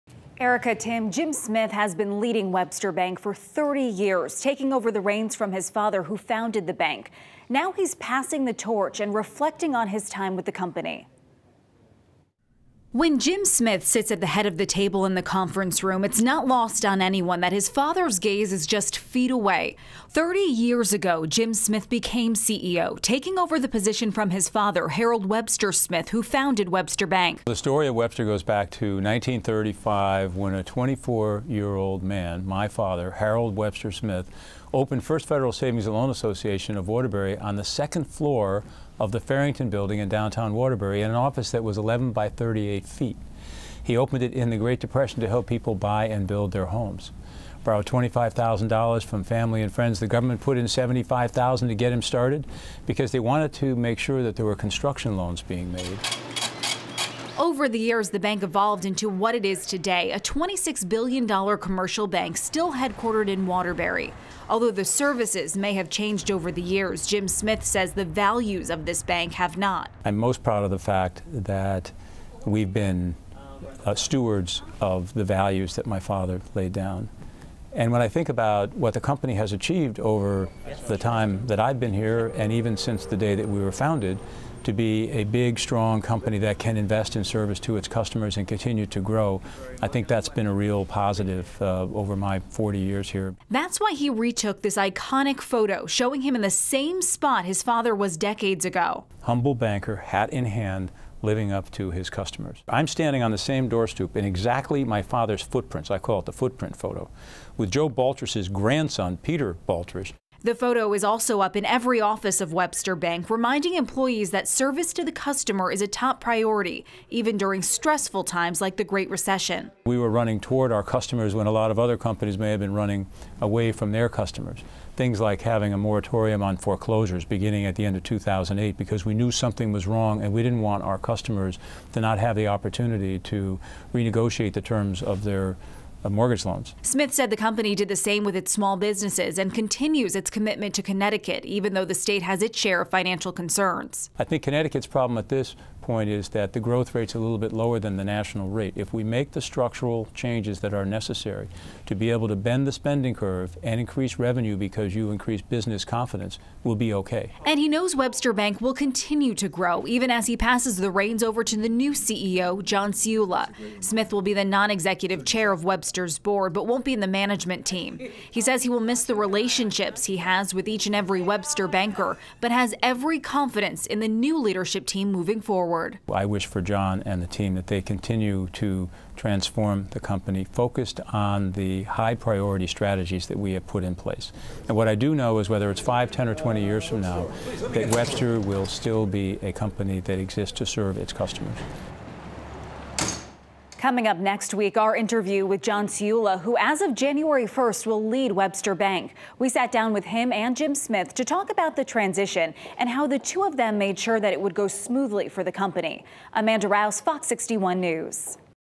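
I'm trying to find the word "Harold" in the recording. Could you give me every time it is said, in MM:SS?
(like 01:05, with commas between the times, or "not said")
00:24, 00:33.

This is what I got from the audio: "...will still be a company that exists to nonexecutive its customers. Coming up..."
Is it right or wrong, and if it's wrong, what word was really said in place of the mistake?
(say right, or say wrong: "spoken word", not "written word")
wrong: "serve", not "nonexecutive".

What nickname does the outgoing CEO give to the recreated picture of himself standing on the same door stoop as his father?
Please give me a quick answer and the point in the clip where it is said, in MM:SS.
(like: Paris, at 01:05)
the footprint photo, at 01:46.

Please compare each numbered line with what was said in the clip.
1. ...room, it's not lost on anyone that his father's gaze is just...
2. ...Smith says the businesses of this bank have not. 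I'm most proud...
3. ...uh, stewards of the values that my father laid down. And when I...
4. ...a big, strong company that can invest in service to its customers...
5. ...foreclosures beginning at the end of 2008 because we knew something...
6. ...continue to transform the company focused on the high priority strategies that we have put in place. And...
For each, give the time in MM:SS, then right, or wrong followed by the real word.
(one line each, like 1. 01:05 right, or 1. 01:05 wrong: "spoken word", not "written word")
1. 00:15 right
2. 01:07 wrong: "values", not "businesses"
3. 01:13 right
4. 01:25 right
5. 02:06 right
6. 02:57 right.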